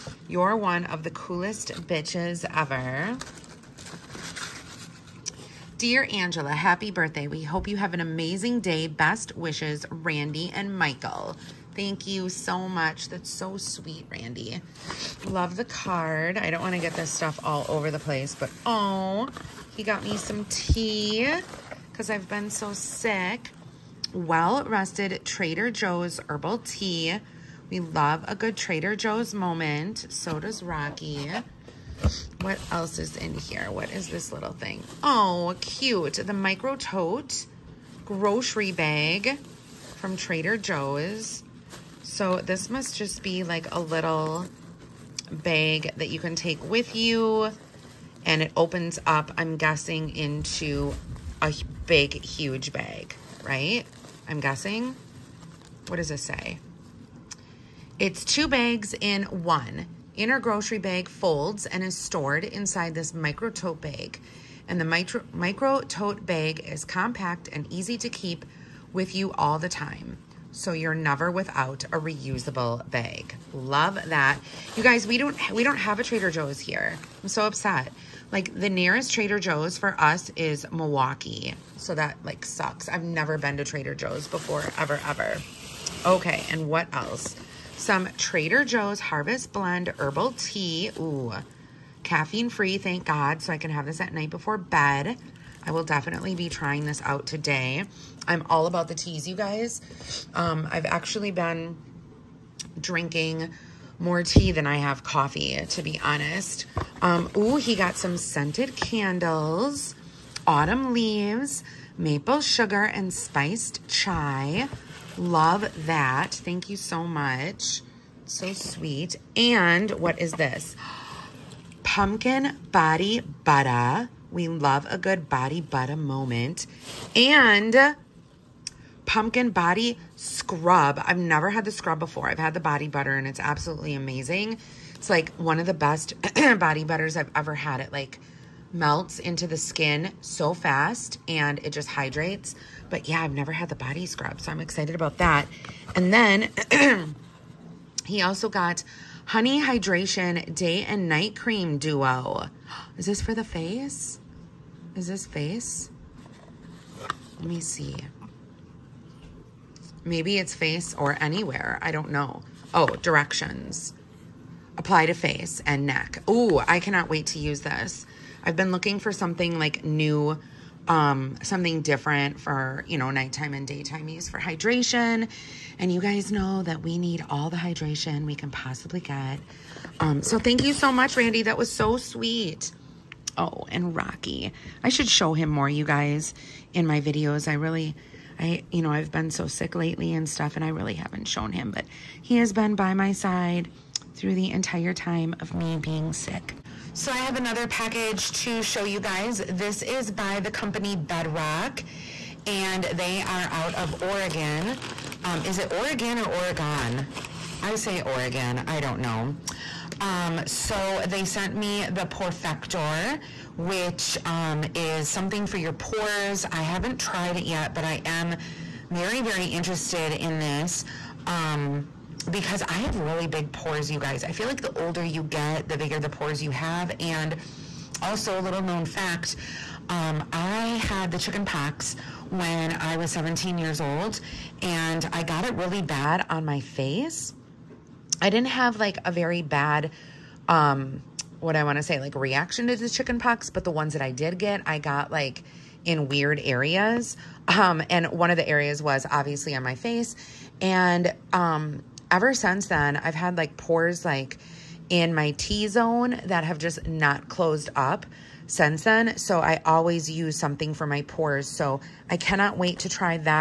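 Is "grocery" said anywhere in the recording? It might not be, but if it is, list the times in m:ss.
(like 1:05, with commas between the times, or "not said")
0:38, 1:00.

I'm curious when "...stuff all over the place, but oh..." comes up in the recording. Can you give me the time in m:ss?
0:17.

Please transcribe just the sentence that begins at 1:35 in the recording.
I will definitely be trying this out today.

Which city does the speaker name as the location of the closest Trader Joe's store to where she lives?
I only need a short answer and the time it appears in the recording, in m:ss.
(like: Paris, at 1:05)
Milwaukee, at 1:20.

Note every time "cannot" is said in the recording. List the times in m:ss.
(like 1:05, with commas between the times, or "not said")
2:46, 4:22.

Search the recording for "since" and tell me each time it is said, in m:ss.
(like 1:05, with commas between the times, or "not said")
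4:12, 4:18.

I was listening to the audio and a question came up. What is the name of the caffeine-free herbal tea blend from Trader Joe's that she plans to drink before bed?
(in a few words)
Harvest Blend.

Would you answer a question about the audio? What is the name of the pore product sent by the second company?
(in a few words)
the Perfector.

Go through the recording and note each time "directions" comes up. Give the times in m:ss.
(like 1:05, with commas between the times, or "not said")
2:42.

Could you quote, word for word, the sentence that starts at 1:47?
Um, ooh, he got some scented candles, autumn leaves, maple sugar, and spiced chai.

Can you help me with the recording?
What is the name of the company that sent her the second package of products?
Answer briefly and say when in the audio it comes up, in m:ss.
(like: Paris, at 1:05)
Bedrock, at 3:20.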